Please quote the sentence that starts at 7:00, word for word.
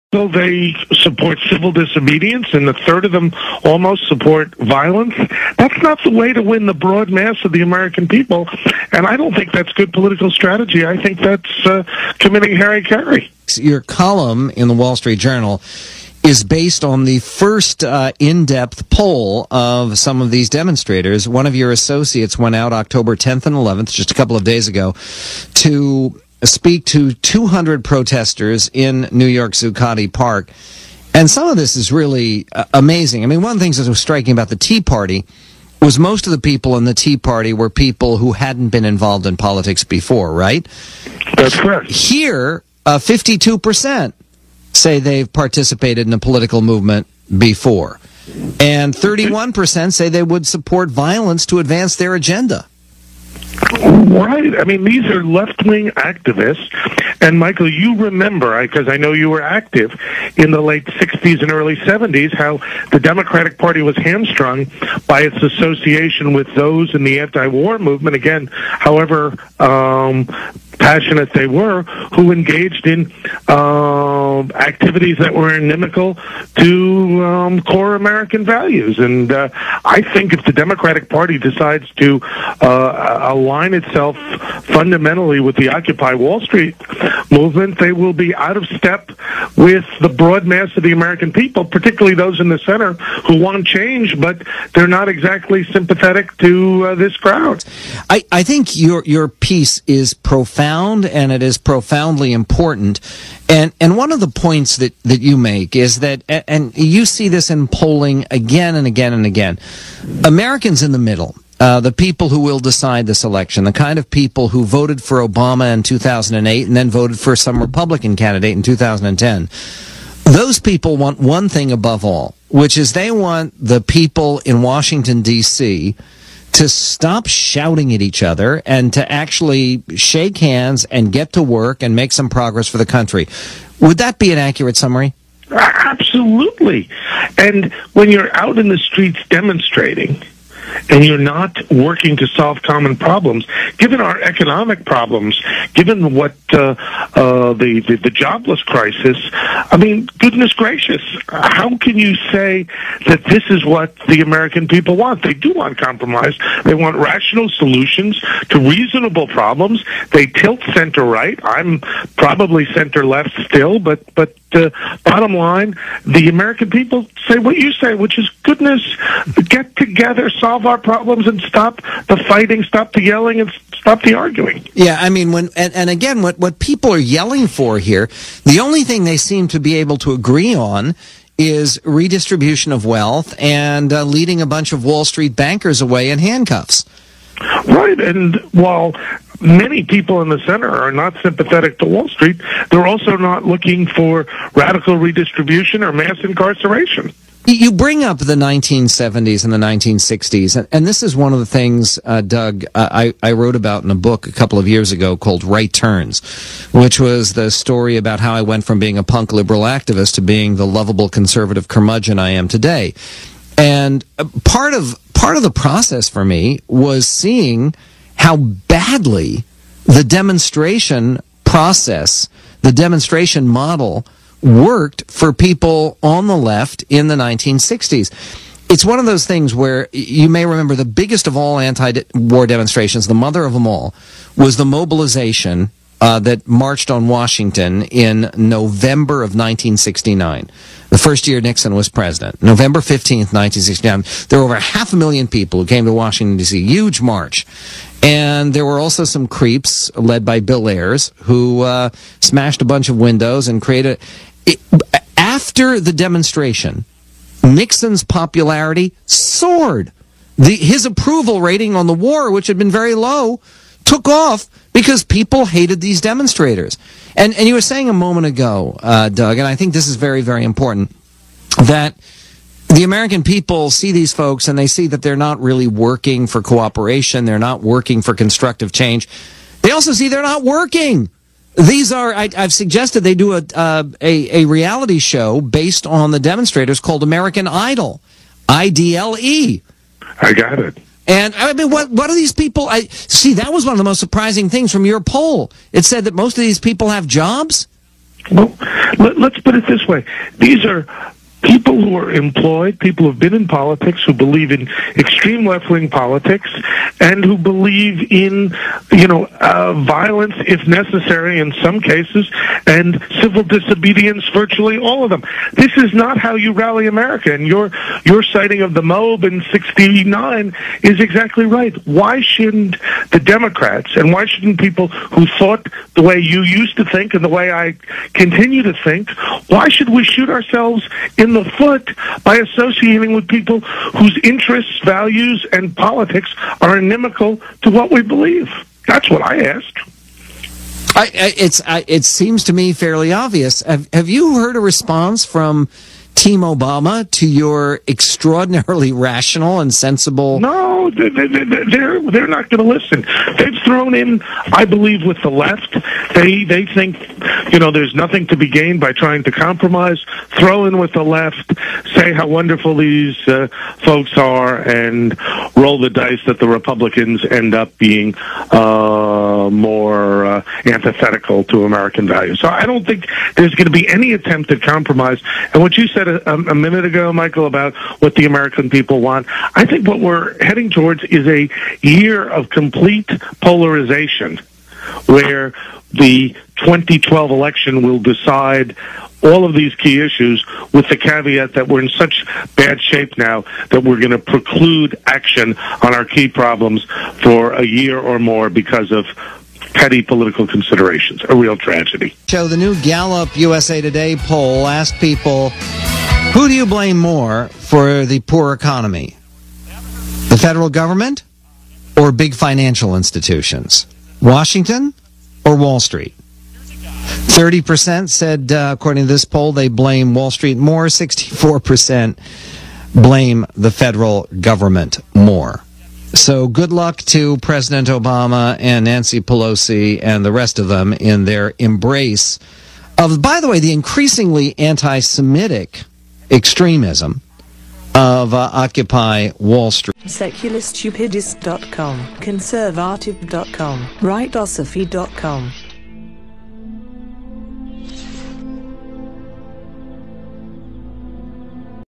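64% blame the federal government more.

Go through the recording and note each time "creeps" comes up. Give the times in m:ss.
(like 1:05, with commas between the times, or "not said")
4:09.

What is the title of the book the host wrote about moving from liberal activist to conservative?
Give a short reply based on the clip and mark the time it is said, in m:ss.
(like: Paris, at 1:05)
Right Turns, at 3:25.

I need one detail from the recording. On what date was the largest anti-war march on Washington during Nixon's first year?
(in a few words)
November 15th, 1969.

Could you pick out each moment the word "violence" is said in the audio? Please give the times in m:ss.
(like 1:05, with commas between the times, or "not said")
0:04, 0:50, 5:09.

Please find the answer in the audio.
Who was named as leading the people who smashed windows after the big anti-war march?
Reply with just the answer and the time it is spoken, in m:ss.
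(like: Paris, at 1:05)
Bill Ayers, at 4:10.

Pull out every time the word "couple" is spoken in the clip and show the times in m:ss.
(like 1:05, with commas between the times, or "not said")
0:24, 3:24.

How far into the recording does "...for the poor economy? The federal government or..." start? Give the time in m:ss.
6:47.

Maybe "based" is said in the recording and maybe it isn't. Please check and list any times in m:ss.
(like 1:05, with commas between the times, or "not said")
0:16, 4:45.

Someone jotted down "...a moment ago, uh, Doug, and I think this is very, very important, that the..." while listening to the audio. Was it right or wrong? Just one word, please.
right.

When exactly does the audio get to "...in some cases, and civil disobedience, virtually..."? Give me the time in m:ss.
5:11.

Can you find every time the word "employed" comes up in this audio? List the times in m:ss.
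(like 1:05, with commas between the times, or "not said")
5:02.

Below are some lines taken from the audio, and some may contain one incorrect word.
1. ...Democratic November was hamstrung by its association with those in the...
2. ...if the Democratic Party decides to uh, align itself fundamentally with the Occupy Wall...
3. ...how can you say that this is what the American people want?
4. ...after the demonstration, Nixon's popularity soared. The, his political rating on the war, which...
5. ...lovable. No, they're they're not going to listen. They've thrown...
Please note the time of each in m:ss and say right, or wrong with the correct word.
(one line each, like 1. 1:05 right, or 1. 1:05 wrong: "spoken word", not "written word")
1. 1:02 wrong: "Party", not "November"
2. 1:20 right
3. 2:31 right
4. 4:15 wrong: "approval", not "political"
5. 5:49 wrong: "sensible", not "lovable".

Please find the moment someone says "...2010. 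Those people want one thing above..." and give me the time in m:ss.
1:58.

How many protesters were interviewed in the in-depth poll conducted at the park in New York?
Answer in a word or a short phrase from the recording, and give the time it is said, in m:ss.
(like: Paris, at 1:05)
200, at 0:27.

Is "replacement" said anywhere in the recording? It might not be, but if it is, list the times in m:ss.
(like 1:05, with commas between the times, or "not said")
not said.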